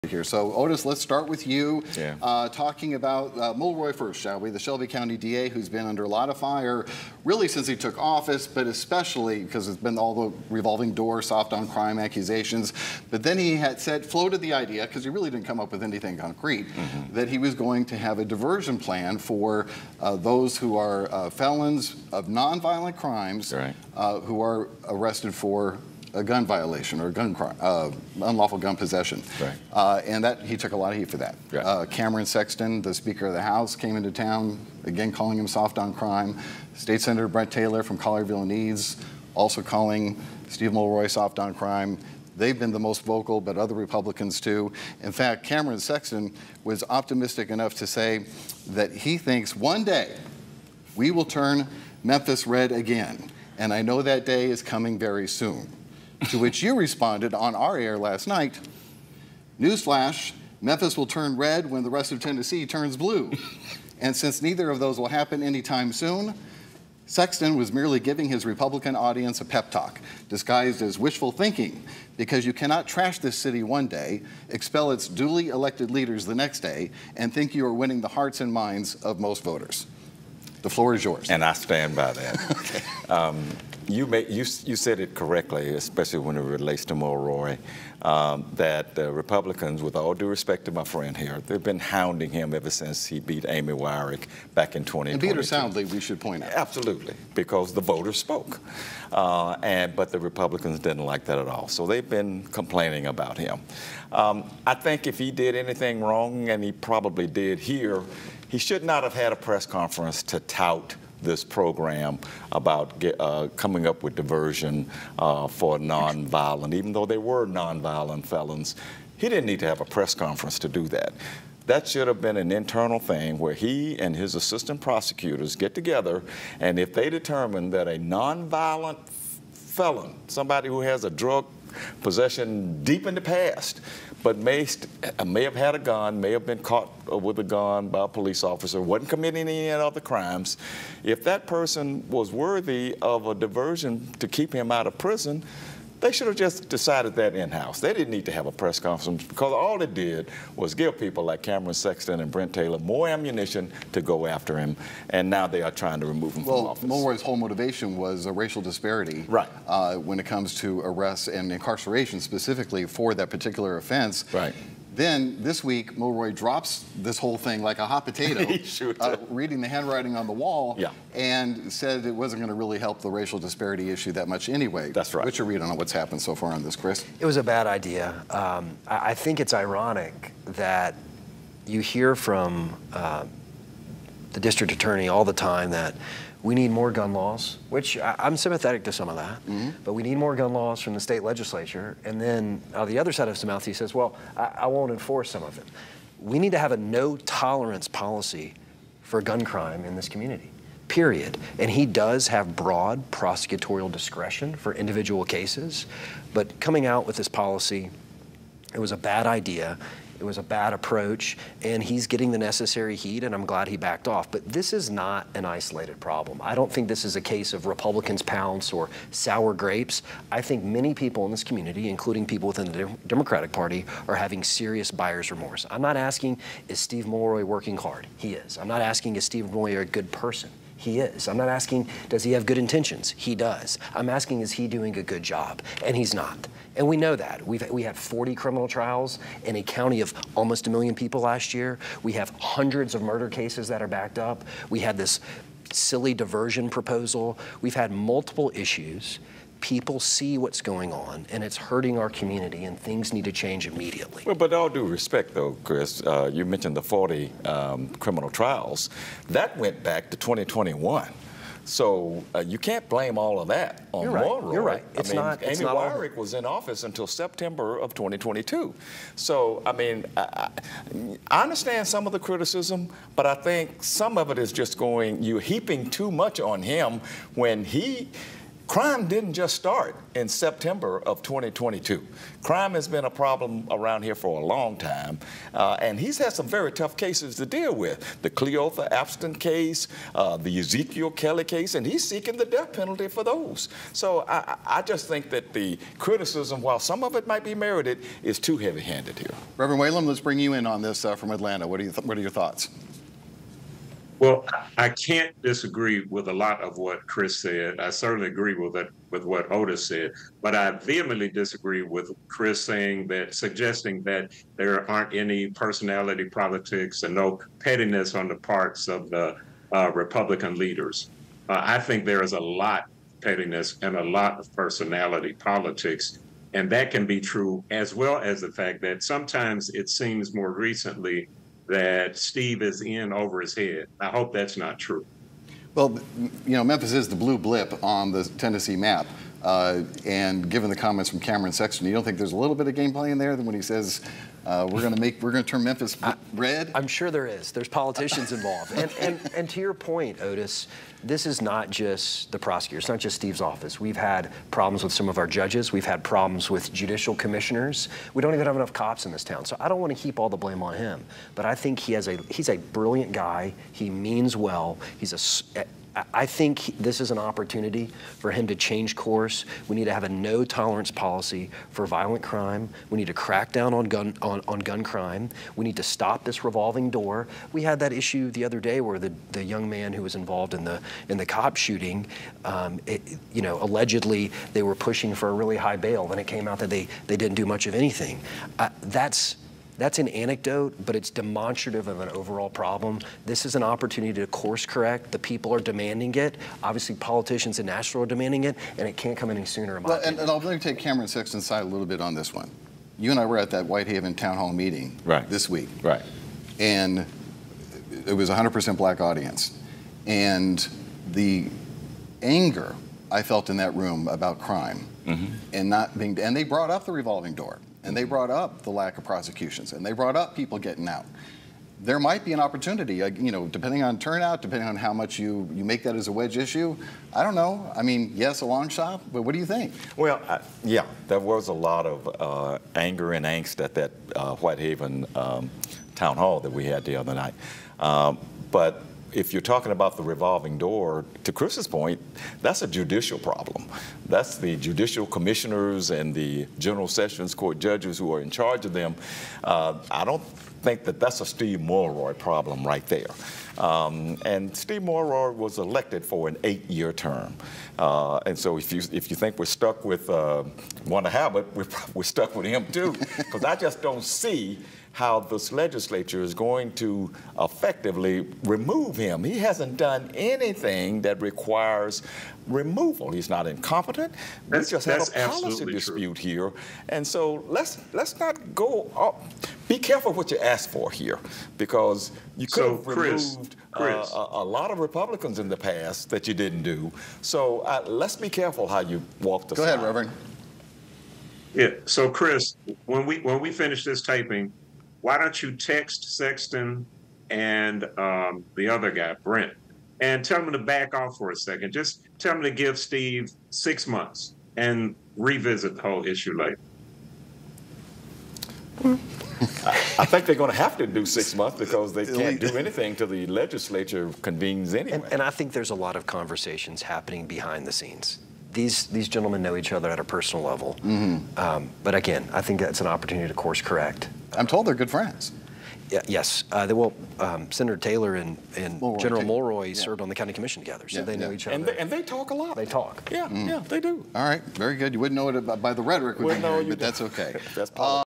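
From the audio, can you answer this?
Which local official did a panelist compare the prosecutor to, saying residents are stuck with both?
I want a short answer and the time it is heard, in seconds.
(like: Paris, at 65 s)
Wanda Halbert, at 460 s.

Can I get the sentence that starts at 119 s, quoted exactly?
He didn't need to have a press conference to do that.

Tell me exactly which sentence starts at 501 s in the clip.
Just tell them to give Steve six months and revisit the whole issue later.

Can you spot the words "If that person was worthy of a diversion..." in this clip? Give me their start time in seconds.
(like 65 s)
141 s.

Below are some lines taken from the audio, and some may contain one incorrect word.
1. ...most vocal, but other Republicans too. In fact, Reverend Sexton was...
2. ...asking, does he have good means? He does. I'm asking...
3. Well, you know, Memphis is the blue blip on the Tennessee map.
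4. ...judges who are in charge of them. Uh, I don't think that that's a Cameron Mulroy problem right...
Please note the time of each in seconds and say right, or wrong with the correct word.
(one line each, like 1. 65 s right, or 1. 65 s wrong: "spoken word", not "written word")
1. 42 s wrong: "Cameron", not "Reverend"
2. 231 s wrong: "intentions", not "means"
3. 335 s right
4. 447 s wrong: "Steve", not "Cameron".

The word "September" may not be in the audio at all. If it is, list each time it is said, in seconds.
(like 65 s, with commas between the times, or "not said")
267 s, 280 s.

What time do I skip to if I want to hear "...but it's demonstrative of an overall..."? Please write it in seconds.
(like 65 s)
390 s.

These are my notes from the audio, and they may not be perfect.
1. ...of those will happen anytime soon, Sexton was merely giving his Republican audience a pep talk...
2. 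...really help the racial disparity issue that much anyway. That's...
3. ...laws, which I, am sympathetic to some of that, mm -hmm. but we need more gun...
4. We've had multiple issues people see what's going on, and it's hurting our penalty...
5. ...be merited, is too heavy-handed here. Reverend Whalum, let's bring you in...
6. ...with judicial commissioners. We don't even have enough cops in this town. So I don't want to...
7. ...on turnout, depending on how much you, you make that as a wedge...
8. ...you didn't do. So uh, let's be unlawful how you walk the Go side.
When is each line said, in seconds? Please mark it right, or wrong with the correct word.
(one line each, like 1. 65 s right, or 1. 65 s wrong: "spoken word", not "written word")
1. 64 s right
2. 172 s right
3. 187 s right
4. 247 s wrong: "community", not "penalty"
5. 297 s right
6. 356 s right
7. 423 s right
8. 486 s wrong: "careful", not "unlawful".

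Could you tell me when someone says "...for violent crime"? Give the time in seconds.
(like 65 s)
371 s.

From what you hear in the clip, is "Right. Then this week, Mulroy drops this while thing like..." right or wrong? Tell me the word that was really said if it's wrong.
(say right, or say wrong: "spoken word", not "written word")
wrong: "whole", not "while".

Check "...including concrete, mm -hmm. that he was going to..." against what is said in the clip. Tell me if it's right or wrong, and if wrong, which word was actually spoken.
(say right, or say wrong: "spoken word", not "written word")
wrong: "anything", not "including".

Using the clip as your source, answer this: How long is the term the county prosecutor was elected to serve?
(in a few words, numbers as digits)
8 years.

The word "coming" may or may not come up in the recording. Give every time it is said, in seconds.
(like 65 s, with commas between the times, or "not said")
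54 s, 113 s, 206 s.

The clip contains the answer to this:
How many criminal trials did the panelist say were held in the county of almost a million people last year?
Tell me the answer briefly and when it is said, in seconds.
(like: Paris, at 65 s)
40, at 237 s.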